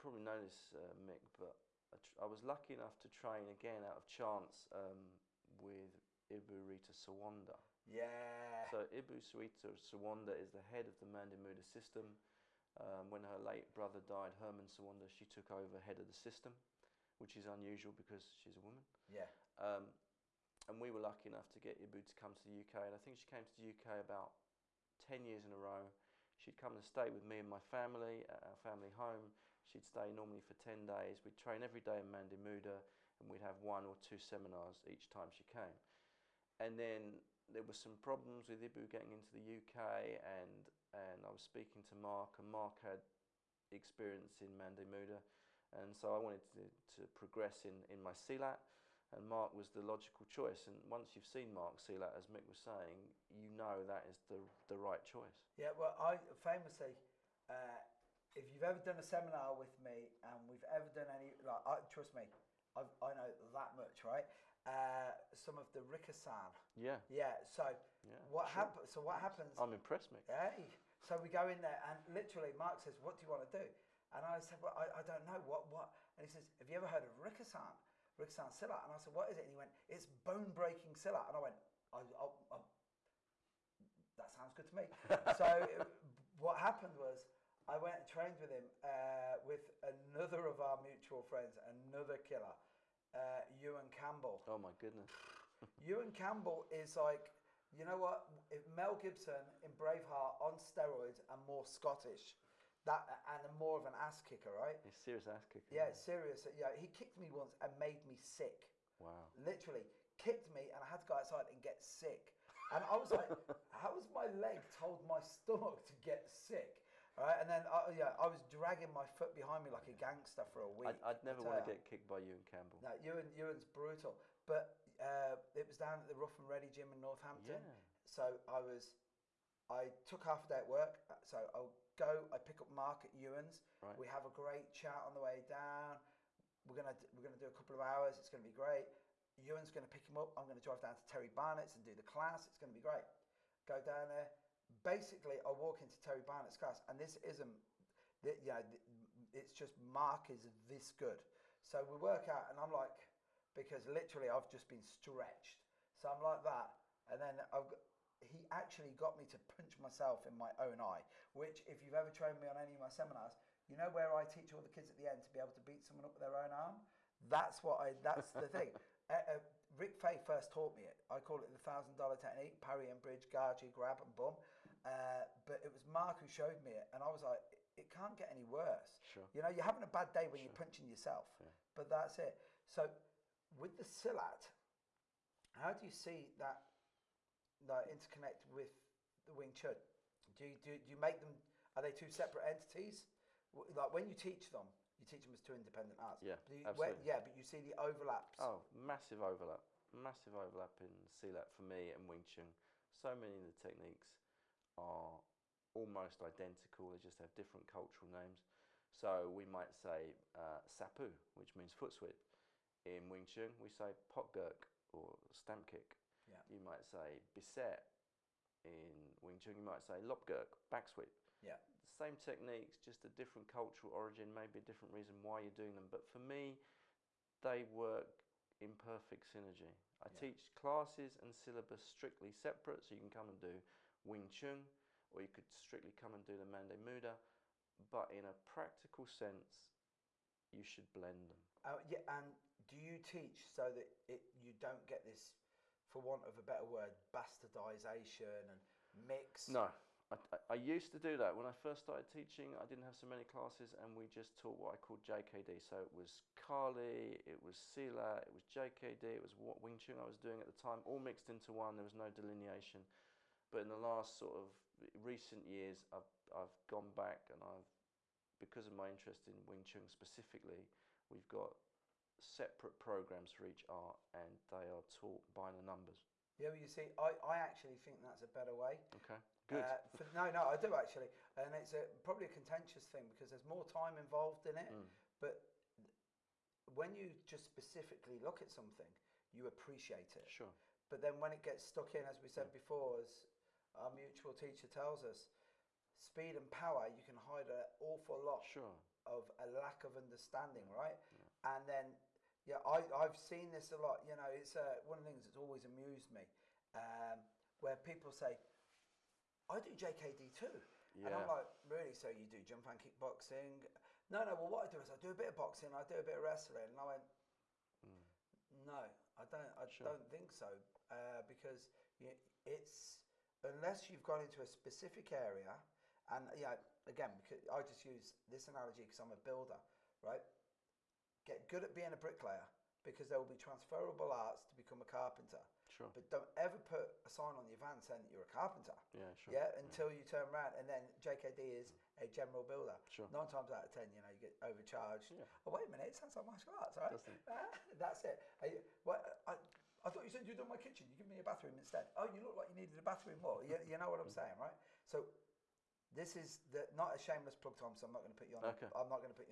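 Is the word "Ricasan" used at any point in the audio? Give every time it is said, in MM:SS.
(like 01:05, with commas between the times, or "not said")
01:05, 01:17.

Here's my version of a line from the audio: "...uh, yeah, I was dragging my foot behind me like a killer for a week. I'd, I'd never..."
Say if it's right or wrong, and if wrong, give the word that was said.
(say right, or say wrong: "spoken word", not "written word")
wrong: "gangster", not "killer".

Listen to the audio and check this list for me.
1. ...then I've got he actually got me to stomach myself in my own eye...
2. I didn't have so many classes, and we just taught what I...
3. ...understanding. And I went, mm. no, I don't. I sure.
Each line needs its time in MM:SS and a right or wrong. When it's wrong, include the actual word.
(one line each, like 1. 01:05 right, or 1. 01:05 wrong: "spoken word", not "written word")
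1. 02:37 wrong: "punch", not "stomach"
2. 04:12 right
3. 05:16 wrong: "wrestling", not "understanding".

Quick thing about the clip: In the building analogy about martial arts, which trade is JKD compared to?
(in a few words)
general builder.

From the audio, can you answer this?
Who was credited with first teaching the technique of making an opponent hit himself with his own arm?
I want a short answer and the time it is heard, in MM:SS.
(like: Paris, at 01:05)
Rick Faye, at 02:49.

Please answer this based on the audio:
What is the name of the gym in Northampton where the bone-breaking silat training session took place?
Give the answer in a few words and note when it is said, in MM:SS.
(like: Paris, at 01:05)
Rough and Ready gym, at 02:06.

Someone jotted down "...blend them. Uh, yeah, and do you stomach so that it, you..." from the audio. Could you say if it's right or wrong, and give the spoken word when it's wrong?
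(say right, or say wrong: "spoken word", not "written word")
wrong: "teach", not "stomach".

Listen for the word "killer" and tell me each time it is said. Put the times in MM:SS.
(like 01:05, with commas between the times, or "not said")
01:32.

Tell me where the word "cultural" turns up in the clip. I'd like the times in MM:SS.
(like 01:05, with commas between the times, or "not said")
03:27, 03:43.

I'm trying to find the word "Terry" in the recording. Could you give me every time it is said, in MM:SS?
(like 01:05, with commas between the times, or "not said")
02:21, 02:25.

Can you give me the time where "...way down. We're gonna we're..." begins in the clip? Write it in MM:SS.
02:15.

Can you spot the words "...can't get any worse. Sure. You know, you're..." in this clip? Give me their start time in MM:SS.
02:57.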